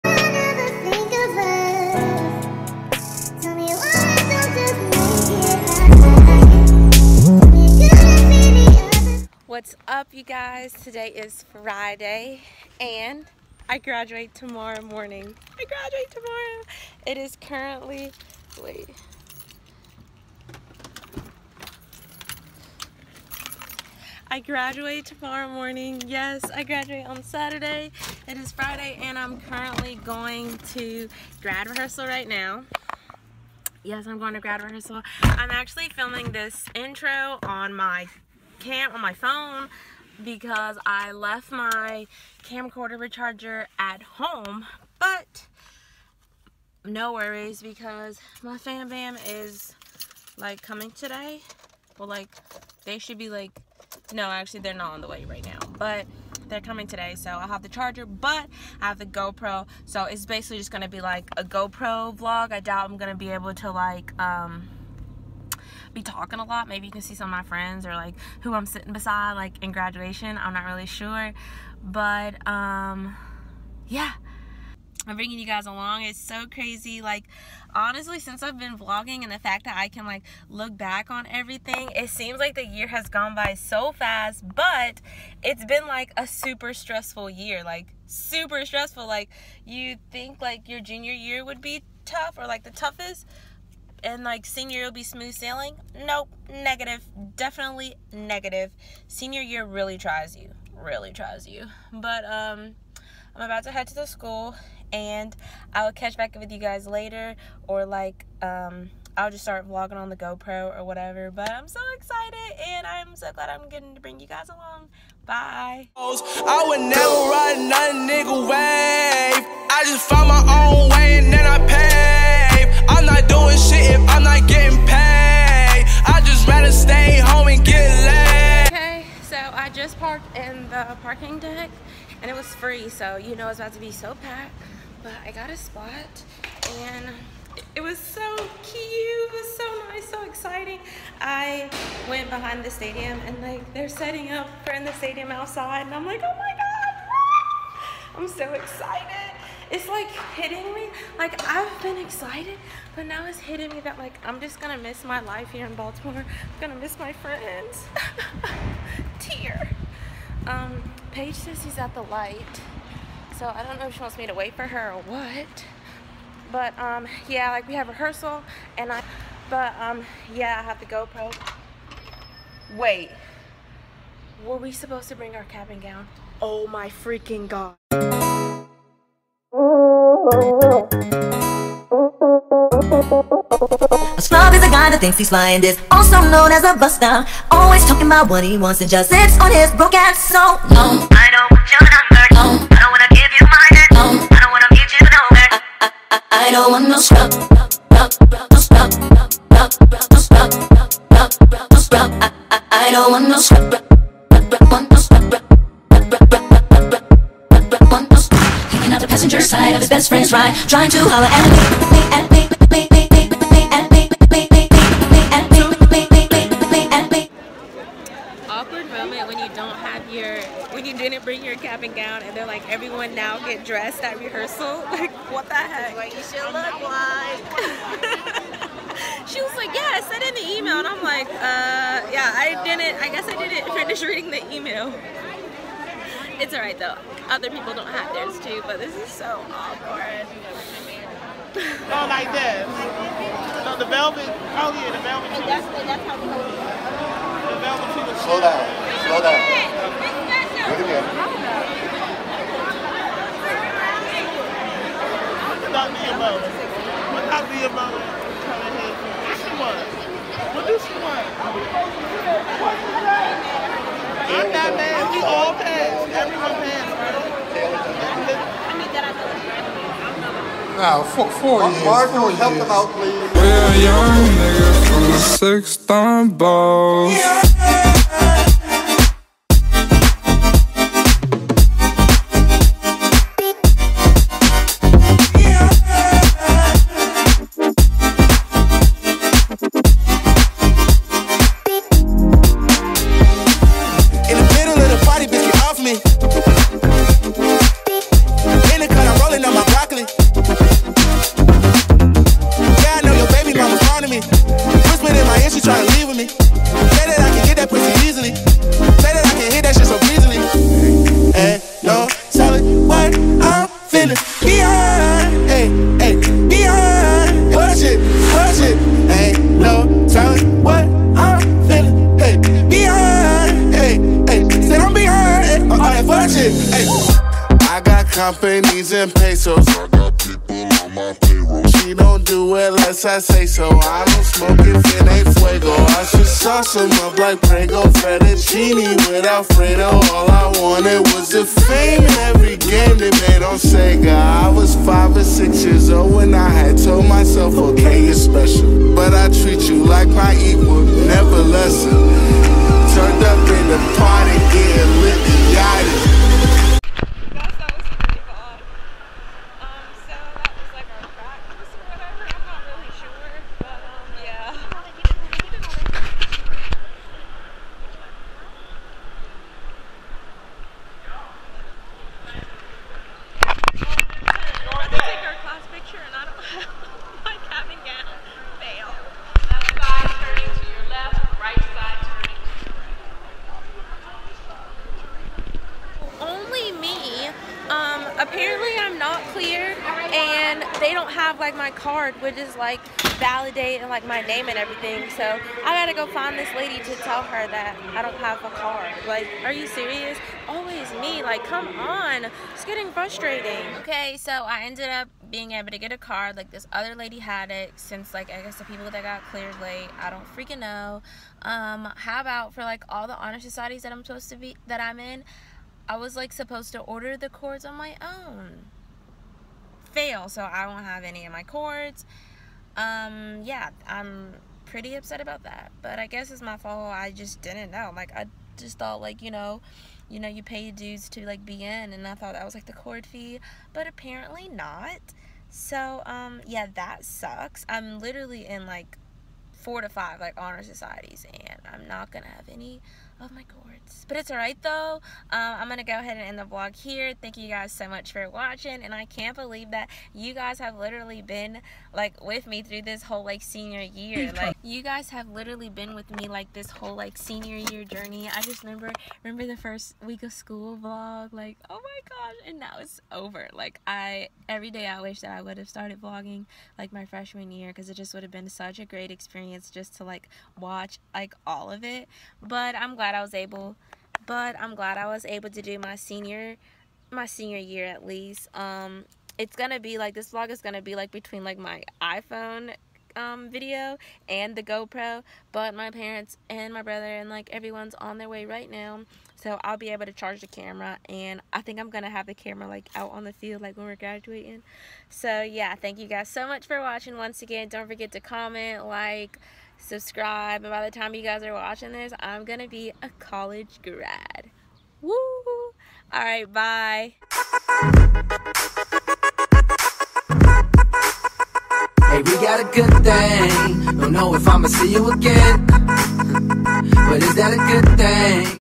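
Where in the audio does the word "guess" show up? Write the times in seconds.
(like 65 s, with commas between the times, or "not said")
233 s, 408 s, 426 s.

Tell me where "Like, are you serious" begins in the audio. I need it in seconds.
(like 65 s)
399 s.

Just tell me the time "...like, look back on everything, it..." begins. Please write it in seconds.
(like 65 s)
80 s.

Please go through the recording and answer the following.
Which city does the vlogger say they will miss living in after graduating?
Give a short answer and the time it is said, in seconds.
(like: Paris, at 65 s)
Baltimore, at 155 s.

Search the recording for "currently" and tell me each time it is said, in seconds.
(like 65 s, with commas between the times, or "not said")
17 s, 29 s.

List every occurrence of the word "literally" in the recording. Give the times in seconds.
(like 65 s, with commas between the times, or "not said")
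437 s, 450 s, 455 s.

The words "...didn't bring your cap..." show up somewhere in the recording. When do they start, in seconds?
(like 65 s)
220 s.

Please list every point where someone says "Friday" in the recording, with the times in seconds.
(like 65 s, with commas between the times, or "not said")
11 s, 28 s.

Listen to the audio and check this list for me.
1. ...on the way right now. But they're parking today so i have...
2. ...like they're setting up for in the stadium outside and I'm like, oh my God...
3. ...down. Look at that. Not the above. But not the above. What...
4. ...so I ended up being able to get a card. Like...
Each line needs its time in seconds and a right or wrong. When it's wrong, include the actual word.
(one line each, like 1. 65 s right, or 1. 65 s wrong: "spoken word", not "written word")
1. 54 s wrong: "coming", not "parking"
2. 143 s right
3. 249 s right
4. 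404 s right.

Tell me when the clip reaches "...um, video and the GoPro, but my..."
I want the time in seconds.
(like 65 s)
483 s.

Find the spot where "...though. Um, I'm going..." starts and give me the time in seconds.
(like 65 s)
444 s.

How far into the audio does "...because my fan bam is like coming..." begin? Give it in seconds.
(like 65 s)
47 s.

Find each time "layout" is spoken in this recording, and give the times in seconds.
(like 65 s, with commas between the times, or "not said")
not said.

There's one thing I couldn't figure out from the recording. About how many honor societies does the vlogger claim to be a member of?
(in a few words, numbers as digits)
4 to 5.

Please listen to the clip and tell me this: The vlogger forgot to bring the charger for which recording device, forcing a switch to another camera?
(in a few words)
camcorder.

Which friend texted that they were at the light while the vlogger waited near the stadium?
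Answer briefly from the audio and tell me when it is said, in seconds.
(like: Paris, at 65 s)
Paige, at 161 s.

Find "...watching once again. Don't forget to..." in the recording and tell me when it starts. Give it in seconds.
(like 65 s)
496 s.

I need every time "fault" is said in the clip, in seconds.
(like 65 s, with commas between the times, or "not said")
426 s.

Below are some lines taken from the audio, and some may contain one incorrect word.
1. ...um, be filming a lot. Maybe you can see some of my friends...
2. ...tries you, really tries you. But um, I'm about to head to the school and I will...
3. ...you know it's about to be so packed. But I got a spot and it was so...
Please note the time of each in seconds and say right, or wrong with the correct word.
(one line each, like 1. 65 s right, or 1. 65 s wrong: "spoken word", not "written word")
1. 64 s wrong: "talking", not "filming"
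2. 99 s right
3. 133 s right.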